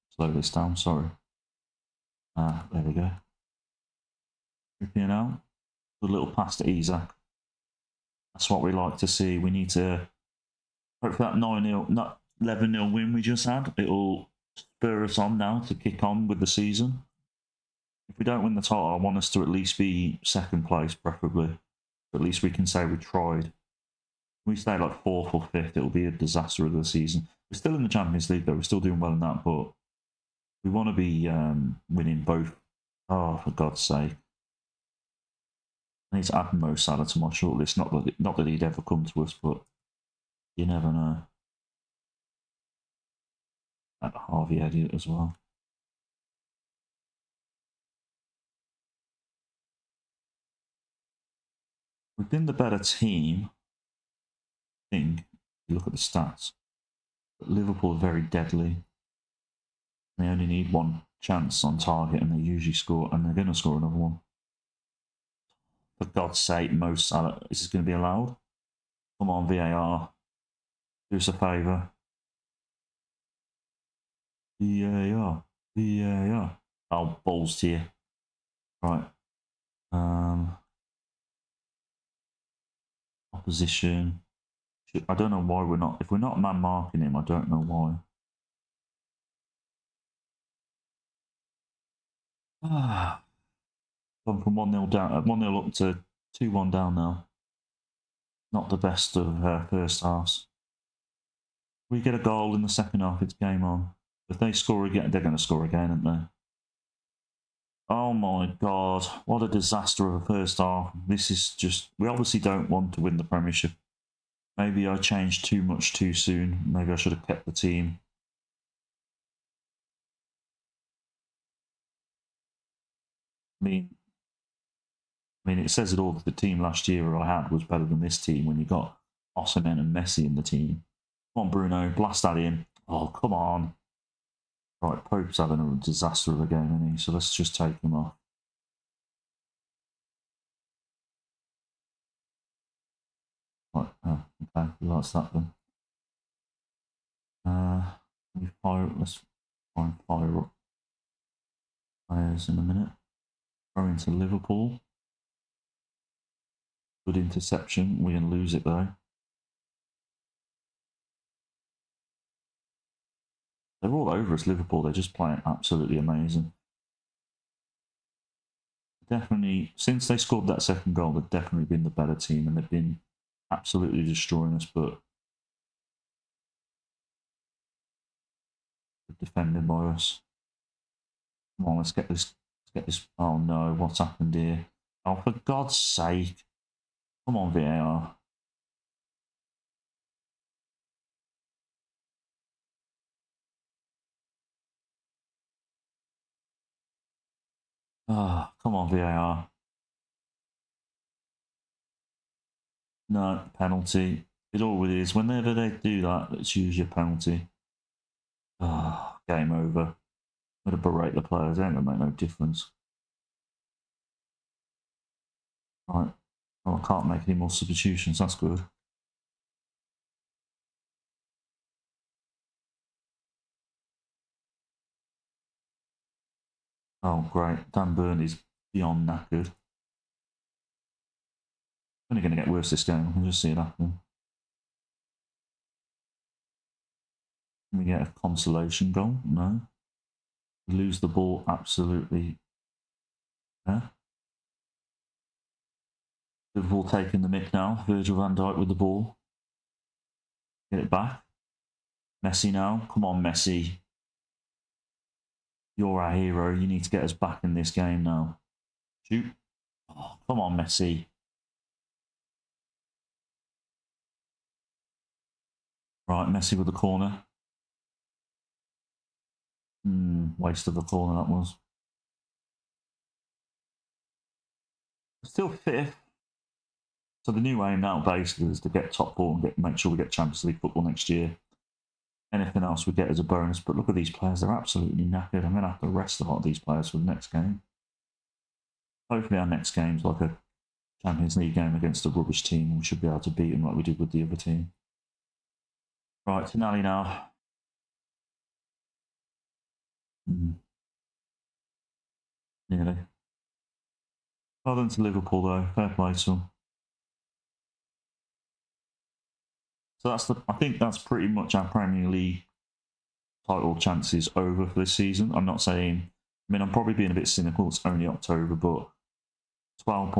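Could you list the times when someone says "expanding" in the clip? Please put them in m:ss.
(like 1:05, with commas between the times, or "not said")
not said.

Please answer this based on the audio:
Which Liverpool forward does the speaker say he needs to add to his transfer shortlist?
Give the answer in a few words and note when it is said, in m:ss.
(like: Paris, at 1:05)
Mo Salah, at 0:36.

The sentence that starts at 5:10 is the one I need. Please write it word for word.
I think that's pretty much our Premier League title chances over for this season.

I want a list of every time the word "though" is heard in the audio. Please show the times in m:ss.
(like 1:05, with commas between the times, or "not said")
0:28, 2:38, 5:05.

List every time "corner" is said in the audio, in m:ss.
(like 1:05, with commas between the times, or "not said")
4:26, 4:30.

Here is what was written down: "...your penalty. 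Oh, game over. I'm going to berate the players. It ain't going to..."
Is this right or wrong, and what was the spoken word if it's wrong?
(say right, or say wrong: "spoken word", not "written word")
right.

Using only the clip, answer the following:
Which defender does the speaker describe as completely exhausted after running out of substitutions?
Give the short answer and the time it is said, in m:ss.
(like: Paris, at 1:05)
Dan Burn, at 3:47.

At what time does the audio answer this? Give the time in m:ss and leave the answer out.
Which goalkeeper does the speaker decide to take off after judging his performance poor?
2:15.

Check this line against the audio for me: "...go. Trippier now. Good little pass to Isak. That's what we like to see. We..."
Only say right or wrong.
right.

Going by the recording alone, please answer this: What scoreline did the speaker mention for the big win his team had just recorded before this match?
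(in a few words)
11-0.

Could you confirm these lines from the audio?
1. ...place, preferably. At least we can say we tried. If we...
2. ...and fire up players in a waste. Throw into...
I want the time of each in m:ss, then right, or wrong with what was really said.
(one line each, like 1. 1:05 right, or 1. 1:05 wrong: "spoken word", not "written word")
1. 0:20 right
2. 2:29 wrong: "minute", not "waste".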